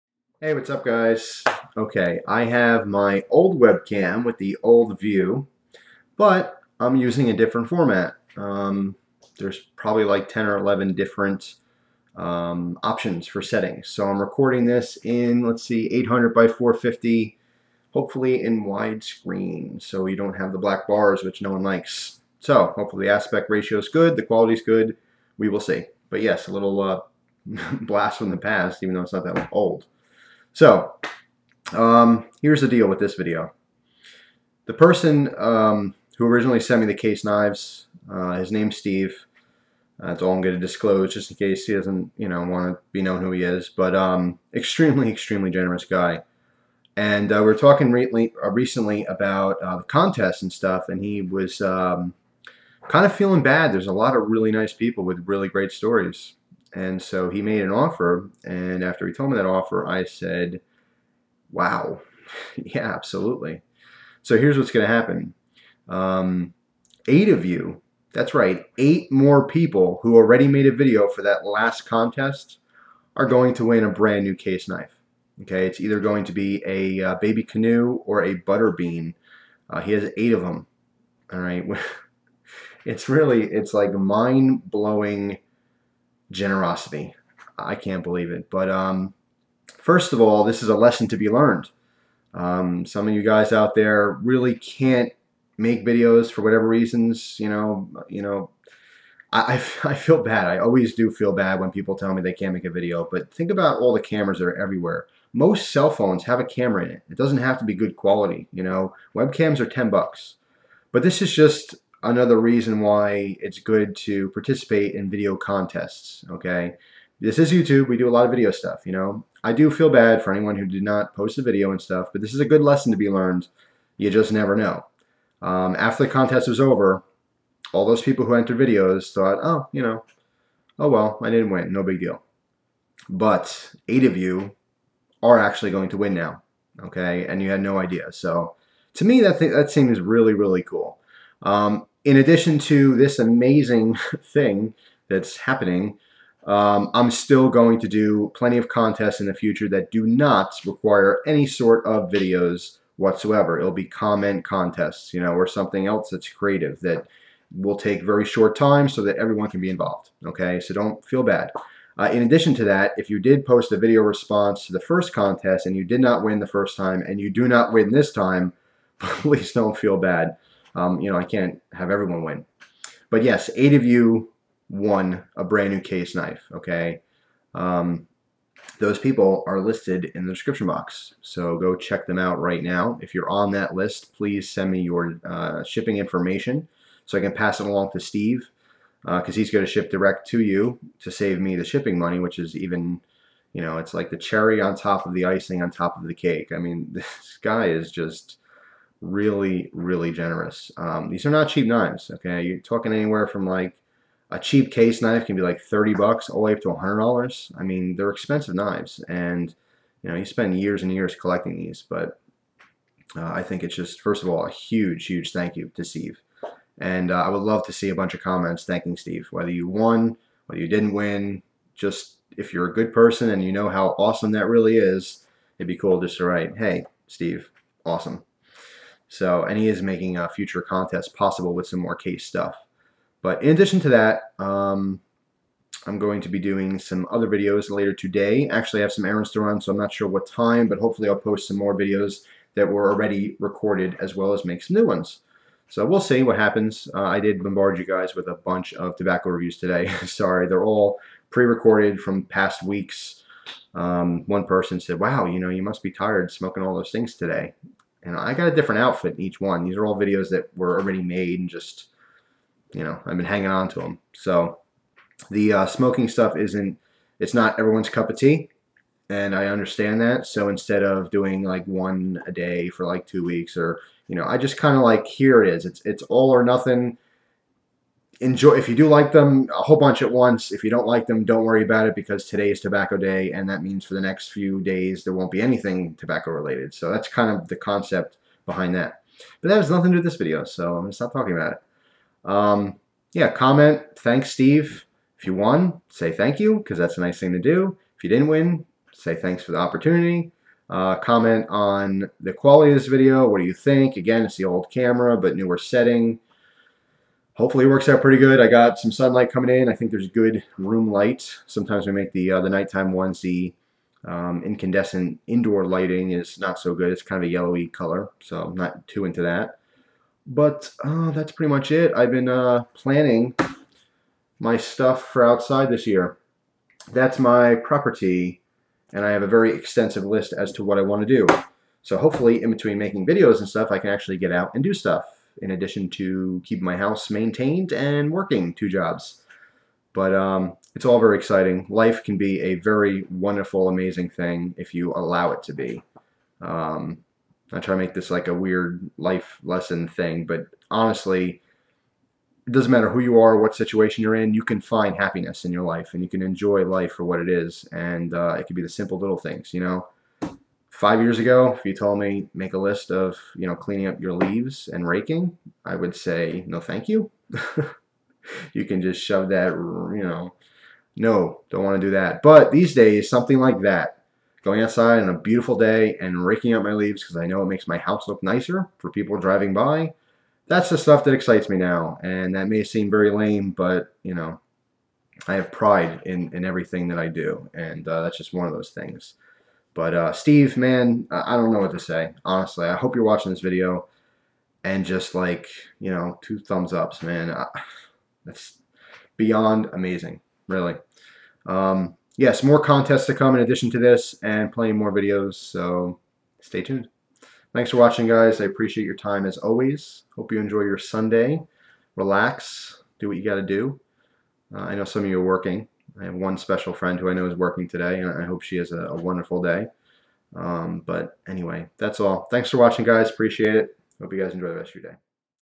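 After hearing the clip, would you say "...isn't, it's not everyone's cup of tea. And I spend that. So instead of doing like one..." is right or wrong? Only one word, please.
wrong.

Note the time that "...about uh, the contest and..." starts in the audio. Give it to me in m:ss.
0:49.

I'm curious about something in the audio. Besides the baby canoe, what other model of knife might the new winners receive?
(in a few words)
butterbean.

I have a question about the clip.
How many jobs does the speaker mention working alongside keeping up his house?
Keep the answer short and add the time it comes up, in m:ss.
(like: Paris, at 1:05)
2, at 5:38.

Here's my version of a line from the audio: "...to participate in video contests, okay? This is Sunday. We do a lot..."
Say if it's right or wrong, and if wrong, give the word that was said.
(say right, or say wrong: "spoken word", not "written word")
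wrong: "YouTube", not "Sunday".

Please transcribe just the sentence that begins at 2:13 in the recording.
But eight of you are actually going to win now, okay?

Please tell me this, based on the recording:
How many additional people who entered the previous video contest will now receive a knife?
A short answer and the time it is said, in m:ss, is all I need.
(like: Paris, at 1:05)
8, at 1:08.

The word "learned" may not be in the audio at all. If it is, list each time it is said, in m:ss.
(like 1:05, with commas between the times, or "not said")
1:31, 2:03.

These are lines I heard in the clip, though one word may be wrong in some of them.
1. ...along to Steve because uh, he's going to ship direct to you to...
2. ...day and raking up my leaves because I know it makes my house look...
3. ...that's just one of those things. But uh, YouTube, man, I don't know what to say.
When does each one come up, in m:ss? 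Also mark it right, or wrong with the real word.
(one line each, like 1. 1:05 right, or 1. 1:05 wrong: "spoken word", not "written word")
1. 3:07 right
2. 6:15 right
3. 6:28 wrong: "Steve", not "YouTube".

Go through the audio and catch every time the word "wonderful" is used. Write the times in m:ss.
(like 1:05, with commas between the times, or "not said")
5:43, 6:58.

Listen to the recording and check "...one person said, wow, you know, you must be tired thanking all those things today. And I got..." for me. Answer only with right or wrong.
wrong.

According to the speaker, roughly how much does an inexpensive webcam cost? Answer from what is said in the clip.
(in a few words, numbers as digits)
10 bucks.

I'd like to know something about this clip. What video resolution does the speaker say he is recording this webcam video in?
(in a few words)
800 by 450.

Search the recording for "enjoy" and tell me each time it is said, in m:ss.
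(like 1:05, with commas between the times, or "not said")
4:38, 5:56, 6:50, 7:04.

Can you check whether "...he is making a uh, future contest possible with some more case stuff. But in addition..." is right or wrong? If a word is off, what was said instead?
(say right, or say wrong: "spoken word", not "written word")
right.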